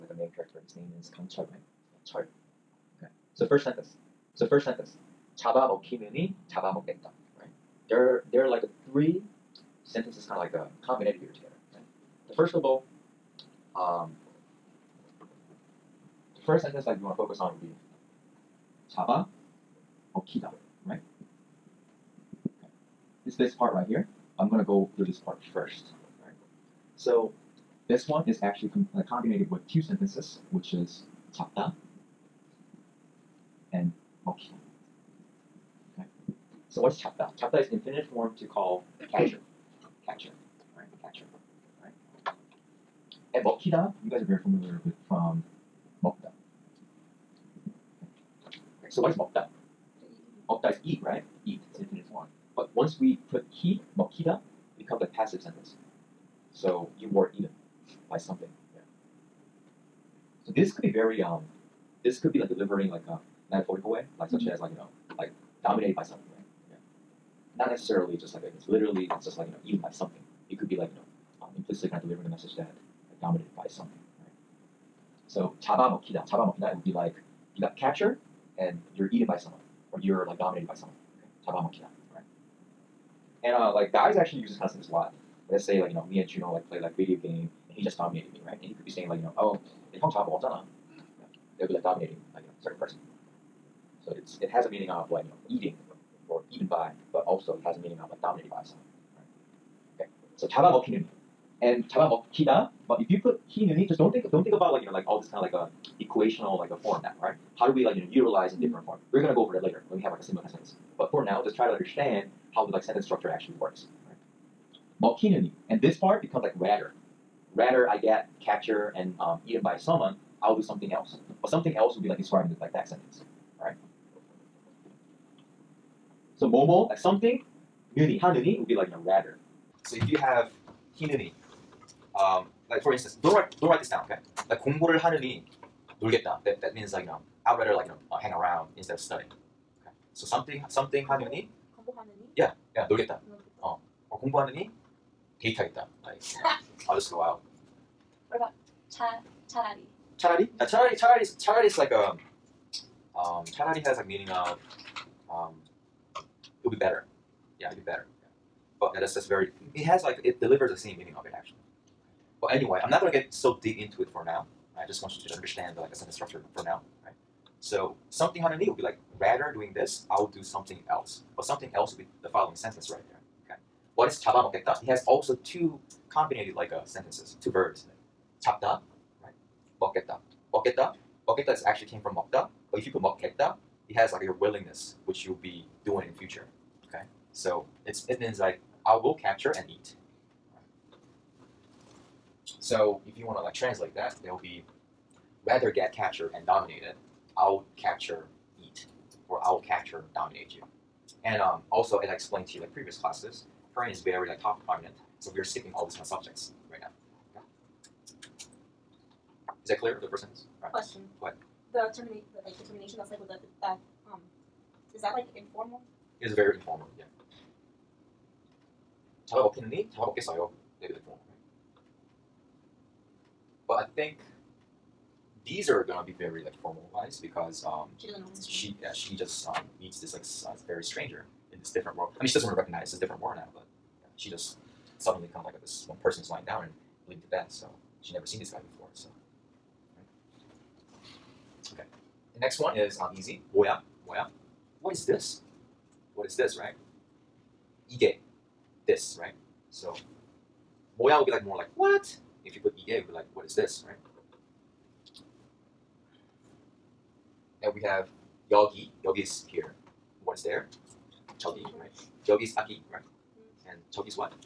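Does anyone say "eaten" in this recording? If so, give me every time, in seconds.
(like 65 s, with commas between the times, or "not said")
57 s, 69 s, 79 s, 119 s.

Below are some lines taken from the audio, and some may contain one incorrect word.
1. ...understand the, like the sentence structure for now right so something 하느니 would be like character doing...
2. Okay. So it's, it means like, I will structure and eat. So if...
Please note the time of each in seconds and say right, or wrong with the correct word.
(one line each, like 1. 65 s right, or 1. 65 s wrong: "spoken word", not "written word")
1. 165 s wrong: "rather", not "character"
2. 186 s wrong: "capture", not "structure".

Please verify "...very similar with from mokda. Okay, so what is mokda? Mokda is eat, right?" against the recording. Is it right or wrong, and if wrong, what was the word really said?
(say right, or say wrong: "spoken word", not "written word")
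wrong: "familiar", not "similar".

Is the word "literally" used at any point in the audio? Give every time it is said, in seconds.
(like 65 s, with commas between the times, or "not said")
68 s.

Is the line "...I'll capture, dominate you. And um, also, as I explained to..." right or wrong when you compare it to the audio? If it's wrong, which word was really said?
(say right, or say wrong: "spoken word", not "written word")
right.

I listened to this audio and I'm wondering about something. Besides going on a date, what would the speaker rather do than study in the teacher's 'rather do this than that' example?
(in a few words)
hang around.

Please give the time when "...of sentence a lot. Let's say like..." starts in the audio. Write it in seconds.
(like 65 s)
84 s.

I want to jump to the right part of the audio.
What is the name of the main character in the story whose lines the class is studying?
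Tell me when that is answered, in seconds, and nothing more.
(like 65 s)
1 s.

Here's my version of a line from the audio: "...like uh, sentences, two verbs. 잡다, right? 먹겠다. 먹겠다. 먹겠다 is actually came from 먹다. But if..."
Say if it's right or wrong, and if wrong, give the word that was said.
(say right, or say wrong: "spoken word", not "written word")
right.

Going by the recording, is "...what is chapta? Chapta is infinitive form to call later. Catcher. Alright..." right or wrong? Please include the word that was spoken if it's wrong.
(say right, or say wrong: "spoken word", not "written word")
wrong: "catcher", not "later".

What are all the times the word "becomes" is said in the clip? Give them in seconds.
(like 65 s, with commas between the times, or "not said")
54 s, 116 s.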